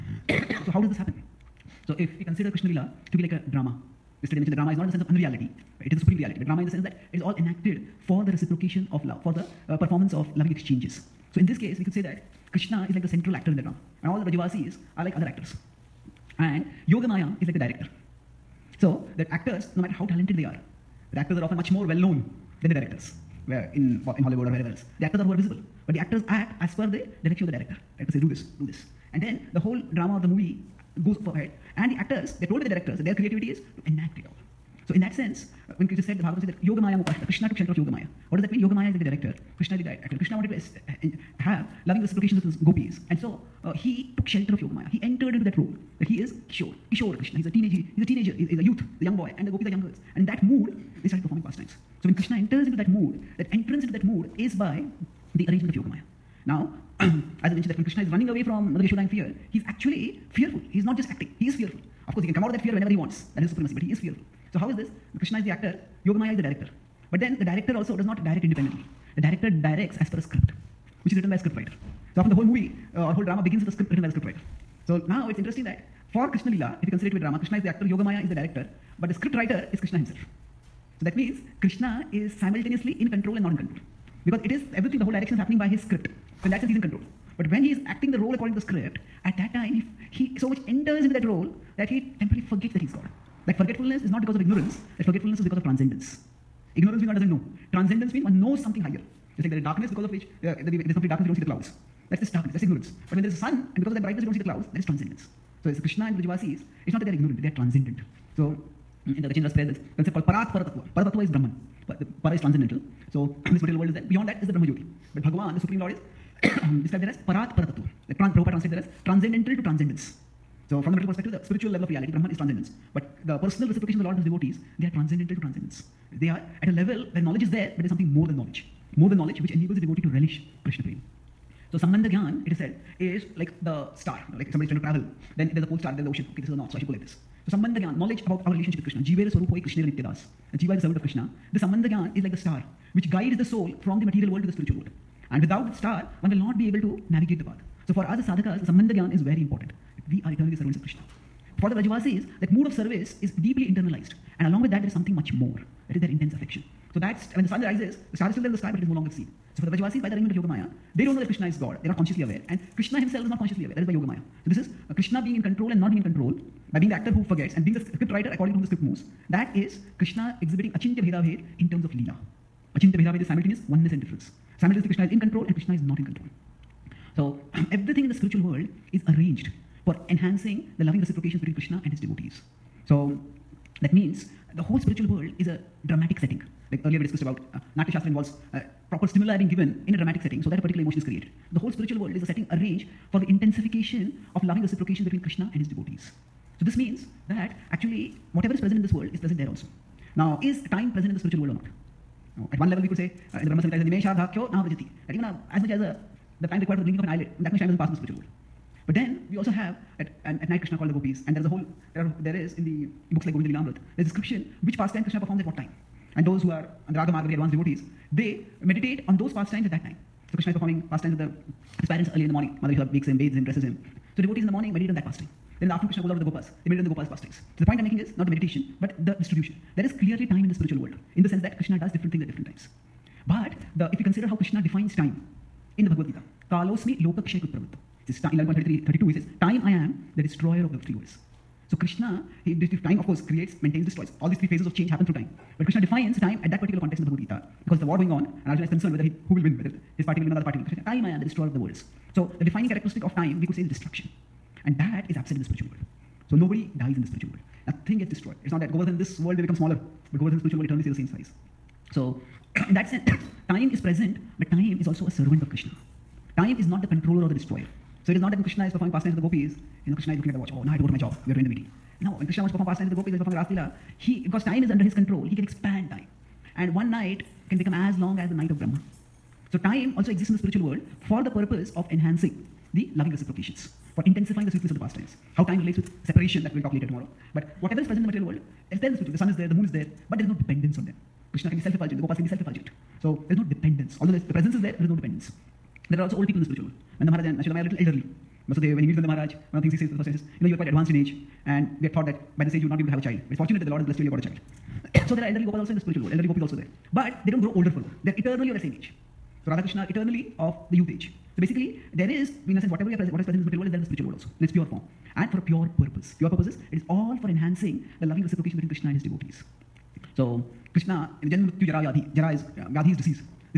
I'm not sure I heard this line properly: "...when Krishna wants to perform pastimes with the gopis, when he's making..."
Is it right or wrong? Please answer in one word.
wrong.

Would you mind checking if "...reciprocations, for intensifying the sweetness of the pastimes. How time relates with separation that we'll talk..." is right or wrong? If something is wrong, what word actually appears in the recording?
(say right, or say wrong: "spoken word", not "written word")
right.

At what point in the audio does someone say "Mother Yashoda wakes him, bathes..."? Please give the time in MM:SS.
03:42.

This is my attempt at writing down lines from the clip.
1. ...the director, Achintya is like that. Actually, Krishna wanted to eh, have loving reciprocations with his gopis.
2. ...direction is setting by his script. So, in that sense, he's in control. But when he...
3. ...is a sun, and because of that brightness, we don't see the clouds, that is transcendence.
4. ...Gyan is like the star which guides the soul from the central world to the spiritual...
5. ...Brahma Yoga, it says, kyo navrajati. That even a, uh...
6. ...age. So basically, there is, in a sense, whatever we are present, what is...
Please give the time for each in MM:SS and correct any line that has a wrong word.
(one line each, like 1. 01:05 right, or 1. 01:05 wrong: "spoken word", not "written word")
1. 00:38 wrong: "Krishna", not "Achintya"
2. 01:25 wrong: "happening", not "setting"
3. 01:43 right
4. 02:21 wrong: "material", not "central"
5. 03:23 wrong: "Samhita", not "Yoga"
6. 05:10 right.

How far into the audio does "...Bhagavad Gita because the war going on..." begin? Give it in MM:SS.
04:07.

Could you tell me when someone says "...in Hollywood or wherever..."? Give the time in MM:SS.
00:24.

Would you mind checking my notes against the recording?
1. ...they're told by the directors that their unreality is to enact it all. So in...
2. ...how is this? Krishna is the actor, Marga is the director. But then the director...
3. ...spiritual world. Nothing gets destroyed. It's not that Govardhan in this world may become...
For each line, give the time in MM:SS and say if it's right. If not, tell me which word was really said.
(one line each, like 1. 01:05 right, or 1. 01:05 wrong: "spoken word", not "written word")
1. 00:32 wrong: "creativity", not "unreality"
2. 01:04 wrong: "Yogamaya", not "Marga"
3. 04:17 right.